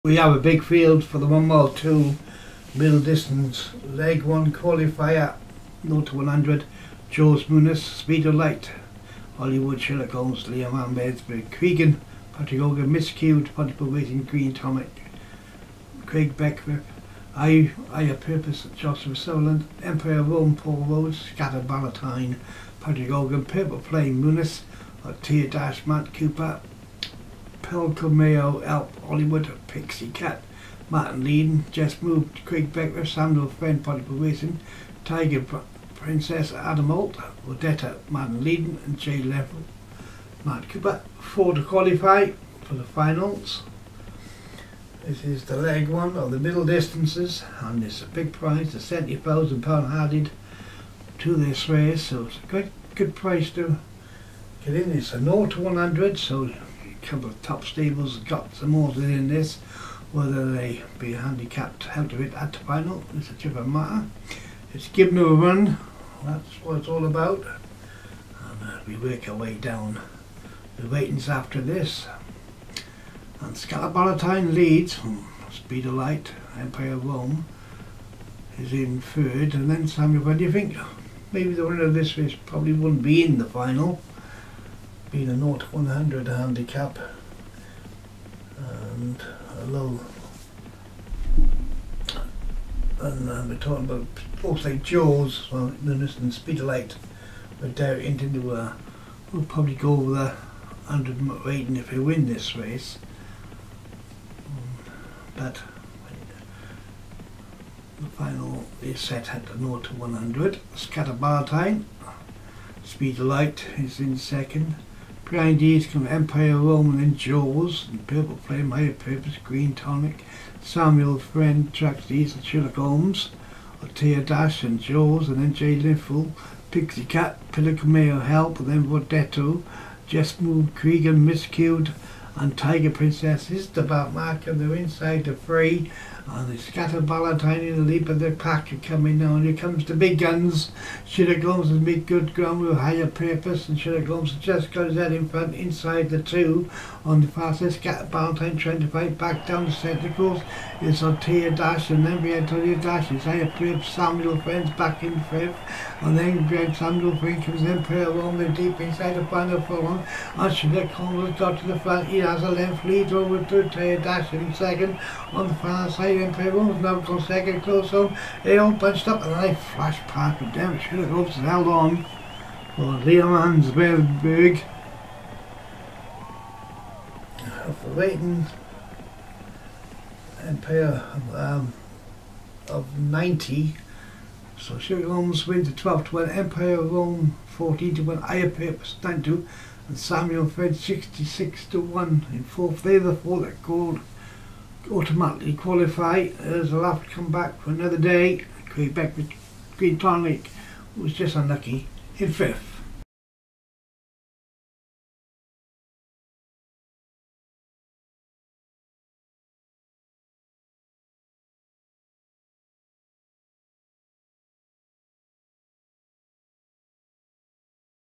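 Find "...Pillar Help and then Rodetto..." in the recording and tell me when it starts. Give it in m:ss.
2:07.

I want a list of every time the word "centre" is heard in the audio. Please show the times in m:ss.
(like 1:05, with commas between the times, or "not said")
2:29.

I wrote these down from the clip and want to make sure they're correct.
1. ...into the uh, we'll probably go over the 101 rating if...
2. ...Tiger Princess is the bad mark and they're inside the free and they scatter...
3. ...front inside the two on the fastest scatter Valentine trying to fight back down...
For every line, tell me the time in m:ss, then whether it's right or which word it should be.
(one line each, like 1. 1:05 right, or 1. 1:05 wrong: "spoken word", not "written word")
1. 1:37 wrong: "100", not "101"
2. 2:12 right
3. 2:25 right.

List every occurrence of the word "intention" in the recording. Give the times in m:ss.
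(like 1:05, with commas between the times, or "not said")
not said.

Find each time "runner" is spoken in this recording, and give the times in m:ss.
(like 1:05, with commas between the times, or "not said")
not said.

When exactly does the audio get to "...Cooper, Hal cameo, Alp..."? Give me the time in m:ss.
0:26.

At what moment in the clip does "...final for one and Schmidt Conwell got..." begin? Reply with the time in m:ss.
2:39.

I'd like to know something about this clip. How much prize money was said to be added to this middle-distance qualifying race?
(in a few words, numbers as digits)
£70,000.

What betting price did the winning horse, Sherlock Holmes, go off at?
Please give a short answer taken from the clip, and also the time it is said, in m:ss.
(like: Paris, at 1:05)
12 to 1, at 3:05.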